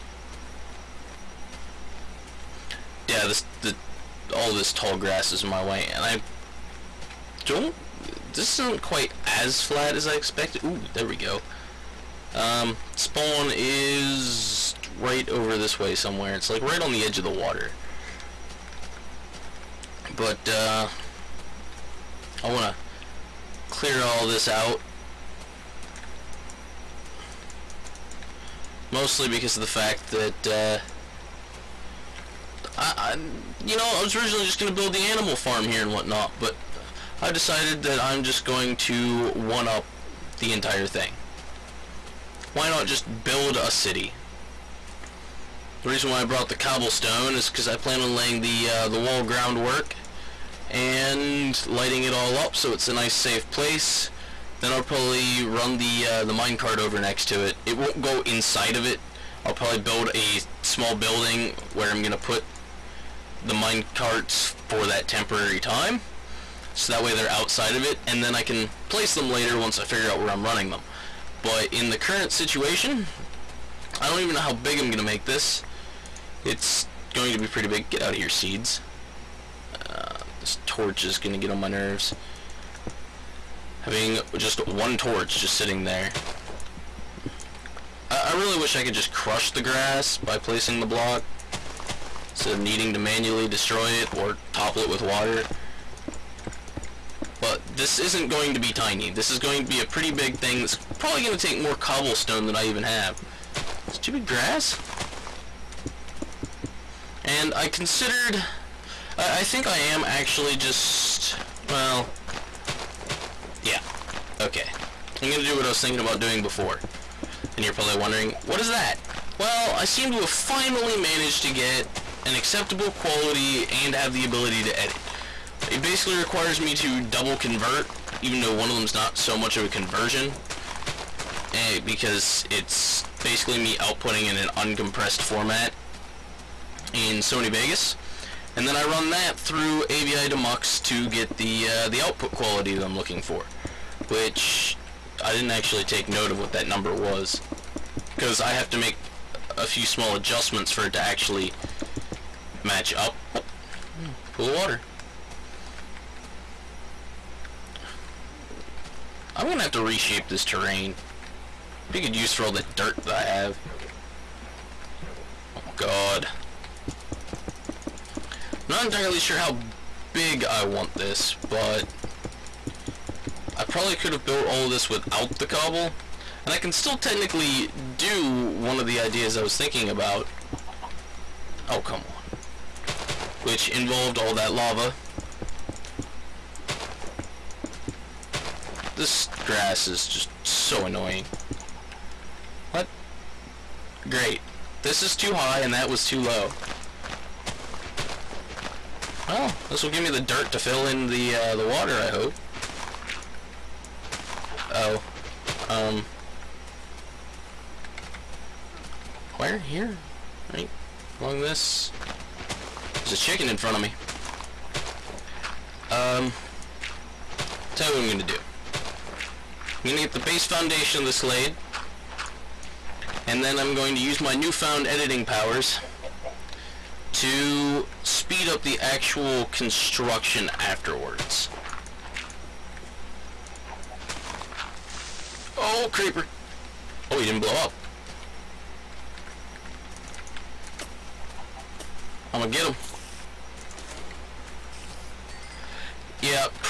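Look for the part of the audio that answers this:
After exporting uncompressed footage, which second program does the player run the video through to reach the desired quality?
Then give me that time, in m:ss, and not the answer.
2:19.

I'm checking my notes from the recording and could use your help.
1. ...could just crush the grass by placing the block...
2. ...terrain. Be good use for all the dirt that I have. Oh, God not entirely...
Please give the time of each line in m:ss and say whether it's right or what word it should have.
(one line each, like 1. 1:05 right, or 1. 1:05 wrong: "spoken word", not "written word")
1. 1:28 right
2. 2:40 right.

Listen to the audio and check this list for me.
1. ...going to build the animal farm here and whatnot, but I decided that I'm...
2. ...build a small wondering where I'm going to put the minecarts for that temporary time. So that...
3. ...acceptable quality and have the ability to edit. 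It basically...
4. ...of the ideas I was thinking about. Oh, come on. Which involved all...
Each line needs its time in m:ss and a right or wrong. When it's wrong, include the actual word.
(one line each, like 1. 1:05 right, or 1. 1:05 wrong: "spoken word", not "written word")
1. 0:34 right
2. 0:59 wrong: "building", not "wondering"
3. 2:02 right
4. 2:58 right.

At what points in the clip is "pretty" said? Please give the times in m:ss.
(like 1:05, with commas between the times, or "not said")
1:17, 1:39.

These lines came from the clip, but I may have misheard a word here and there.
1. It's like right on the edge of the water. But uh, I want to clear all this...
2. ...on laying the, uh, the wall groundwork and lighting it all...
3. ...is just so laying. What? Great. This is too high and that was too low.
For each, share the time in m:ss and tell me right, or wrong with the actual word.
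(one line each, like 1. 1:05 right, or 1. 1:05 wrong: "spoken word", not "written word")
1. 0:16 right
2. 0:48 right
3. 3:09 wrong: "annoying", not "laying".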